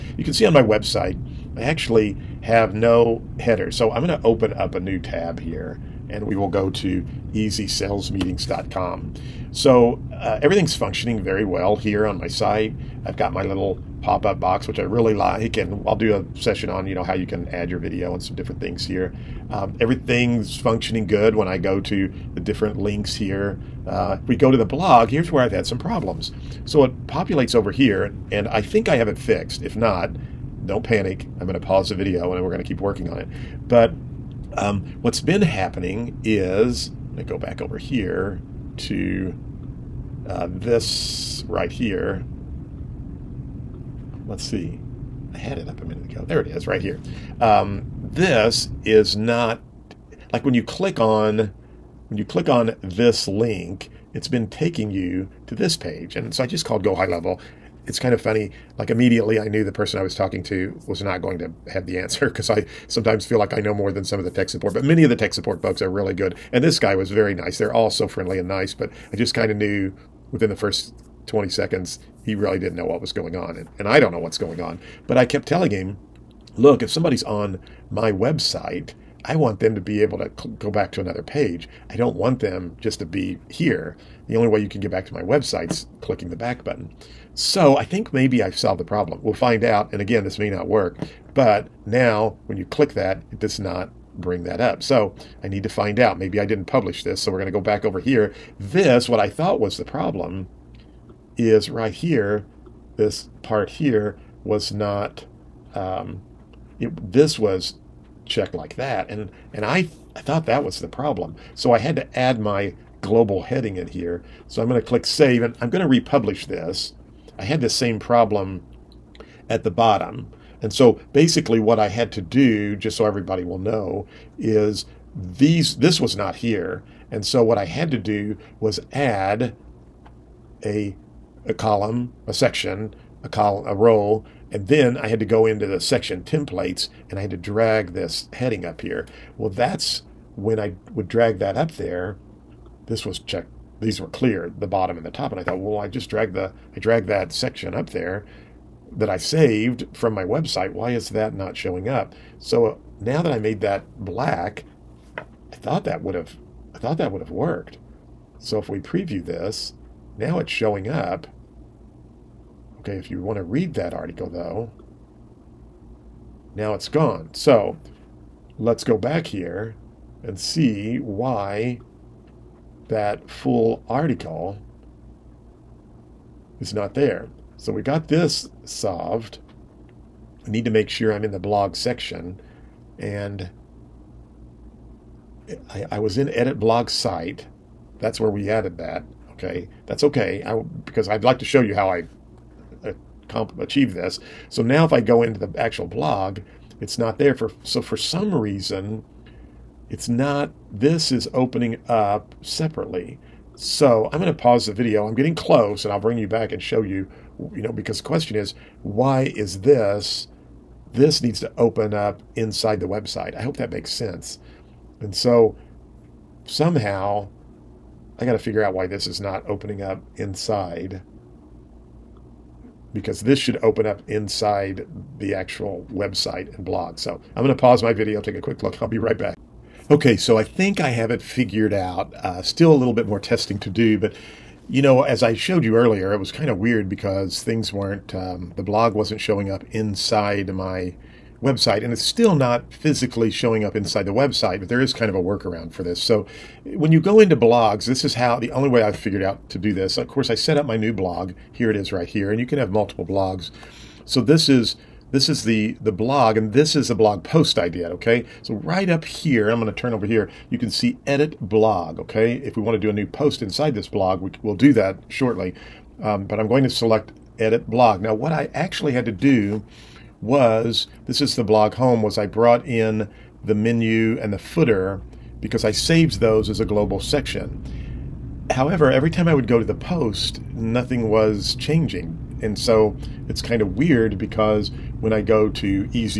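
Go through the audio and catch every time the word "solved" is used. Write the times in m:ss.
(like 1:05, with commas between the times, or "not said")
1:28, 2:58.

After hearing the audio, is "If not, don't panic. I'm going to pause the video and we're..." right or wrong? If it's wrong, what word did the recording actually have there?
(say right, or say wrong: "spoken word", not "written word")
right.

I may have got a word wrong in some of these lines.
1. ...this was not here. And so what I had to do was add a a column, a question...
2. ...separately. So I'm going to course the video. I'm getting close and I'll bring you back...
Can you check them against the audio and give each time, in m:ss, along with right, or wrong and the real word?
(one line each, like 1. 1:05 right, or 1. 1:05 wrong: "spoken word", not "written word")
1. 2:05 wrong: "section", not "question"
2. 3:22 wrong: "pause", not "course".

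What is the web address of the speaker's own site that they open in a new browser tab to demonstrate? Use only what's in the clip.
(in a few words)
easysalesmeetings.com.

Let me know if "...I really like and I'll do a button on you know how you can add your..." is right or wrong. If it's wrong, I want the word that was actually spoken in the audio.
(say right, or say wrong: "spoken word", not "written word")
wrong: "session", not "button".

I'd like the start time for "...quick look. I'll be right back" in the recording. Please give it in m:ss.
3:48.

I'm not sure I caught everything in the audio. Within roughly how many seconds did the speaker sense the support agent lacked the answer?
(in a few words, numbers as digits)
20 seconds.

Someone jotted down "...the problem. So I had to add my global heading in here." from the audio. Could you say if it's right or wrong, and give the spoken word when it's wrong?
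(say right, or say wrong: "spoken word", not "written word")
right.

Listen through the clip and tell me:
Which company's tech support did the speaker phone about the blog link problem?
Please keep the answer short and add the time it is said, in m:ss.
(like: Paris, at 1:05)
Go High Level, at 0:56.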